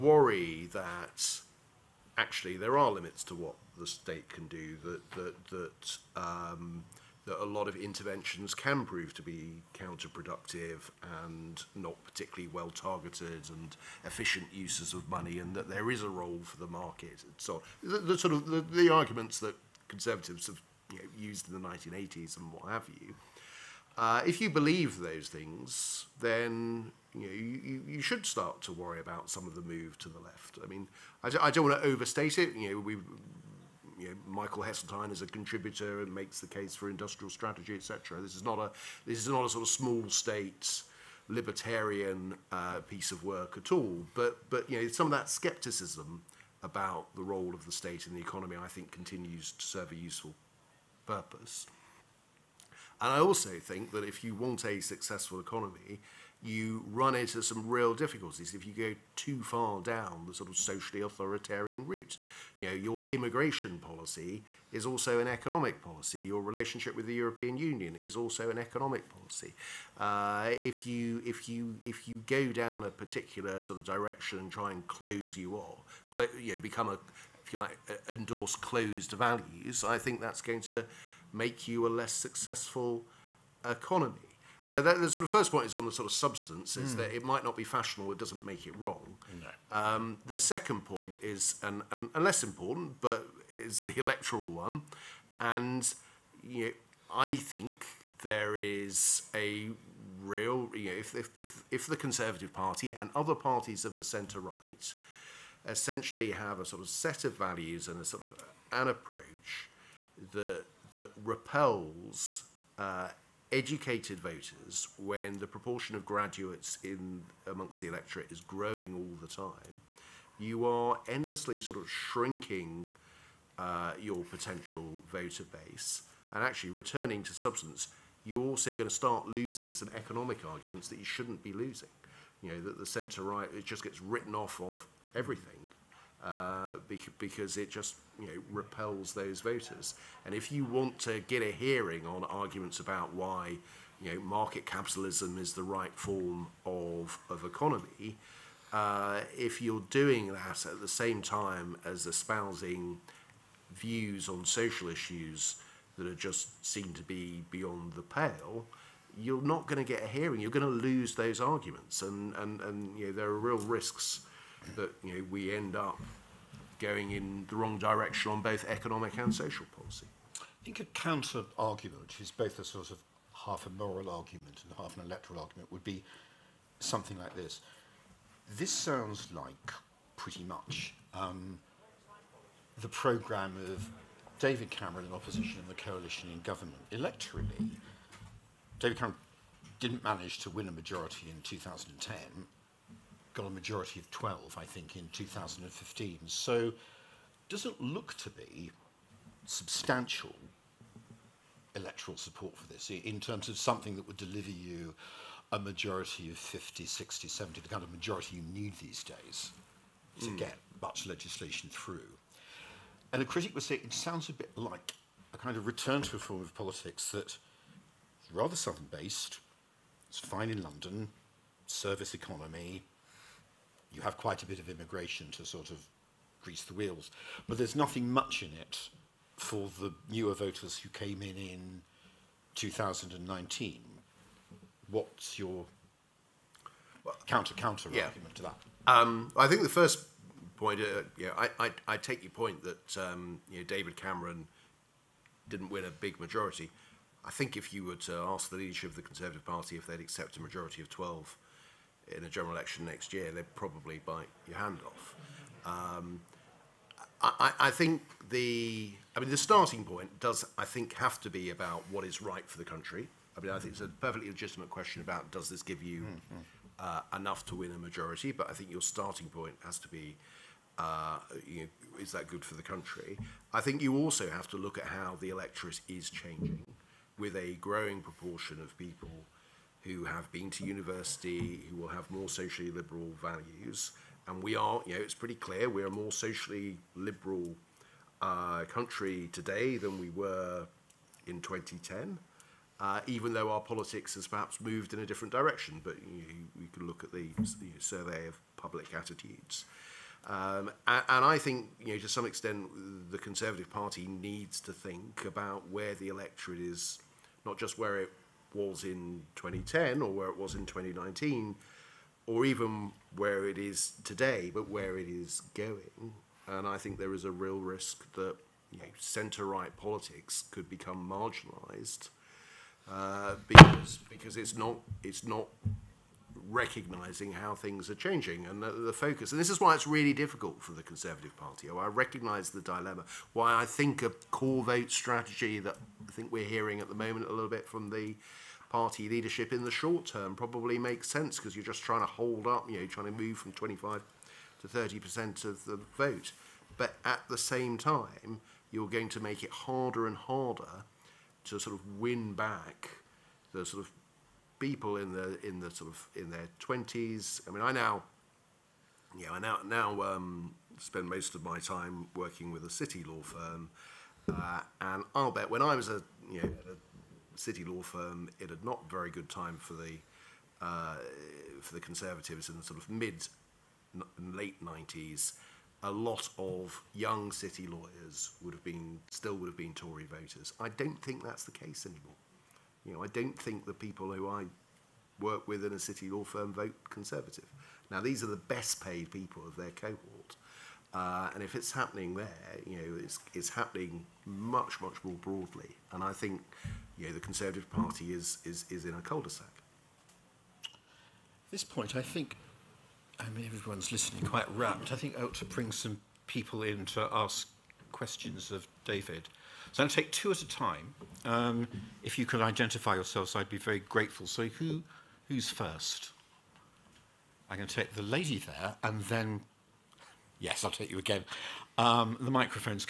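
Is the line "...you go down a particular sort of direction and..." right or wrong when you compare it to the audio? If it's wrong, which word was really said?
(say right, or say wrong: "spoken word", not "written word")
right.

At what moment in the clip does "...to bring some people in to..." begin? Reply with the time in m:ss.
6:45.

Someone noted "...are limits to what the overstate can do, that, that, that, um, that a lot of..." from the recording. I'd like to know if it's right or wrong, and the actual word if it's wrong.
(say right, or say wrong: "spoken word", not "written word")
wrong: "state", not "overstate".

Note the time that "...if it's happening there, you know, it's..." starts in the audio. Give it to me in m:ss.
6:31.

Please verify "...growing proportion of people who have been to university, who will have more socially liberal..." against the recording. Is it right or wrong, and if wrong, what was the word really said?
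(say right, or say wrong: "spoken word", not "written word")
right.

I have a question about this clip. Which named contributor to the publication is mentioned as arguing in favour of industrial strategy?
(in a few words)
Michael Heseltine.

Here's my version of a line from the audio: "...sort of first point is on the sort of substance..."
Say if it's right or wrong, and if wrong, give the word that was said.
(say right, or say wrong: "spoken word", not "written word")
right.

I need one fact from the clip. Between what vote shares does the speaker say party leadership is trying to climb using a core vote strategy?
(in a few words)
25 to 30%.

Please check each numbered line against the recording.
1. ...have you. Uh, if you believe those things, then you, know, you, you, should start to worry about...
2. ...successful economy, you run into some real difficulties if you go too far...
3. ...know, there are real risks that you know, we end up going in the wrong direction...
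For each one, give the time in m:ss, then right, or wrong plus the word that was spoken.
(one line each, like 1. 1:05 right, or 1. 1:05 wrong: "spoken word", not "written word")
1. 0:22 right
2. 0:54 right
3. 2:43 right.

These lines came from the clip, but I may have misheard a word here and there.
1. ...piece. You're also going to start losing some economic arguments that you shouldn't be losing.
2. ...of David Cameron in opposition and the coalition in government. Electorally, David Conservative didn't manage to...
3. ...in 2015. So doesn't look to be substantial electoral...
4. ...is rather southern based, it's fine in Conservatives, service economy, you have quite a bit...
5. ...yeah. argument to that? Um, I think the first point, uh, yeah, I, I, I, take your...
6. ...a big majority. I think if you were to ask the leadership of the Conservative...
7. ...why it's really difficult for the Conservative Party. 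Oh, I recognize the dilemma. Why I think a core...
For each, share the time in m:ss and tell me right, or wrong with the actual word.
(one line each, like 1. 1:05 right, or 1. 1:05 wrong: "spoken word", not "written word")
1. 2:07 wrong: "substance", not "piece"
2. 3:03 wrong: "Cameron", not "Conservative"
3. 3:14 right
4. 3:37 wrong: "London", not "Conservatives"
5. 3:57 right
6. 4:05 right
7. 5:29 right.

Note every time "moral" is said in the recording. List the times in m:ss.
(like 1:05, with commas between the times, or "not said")
2:53.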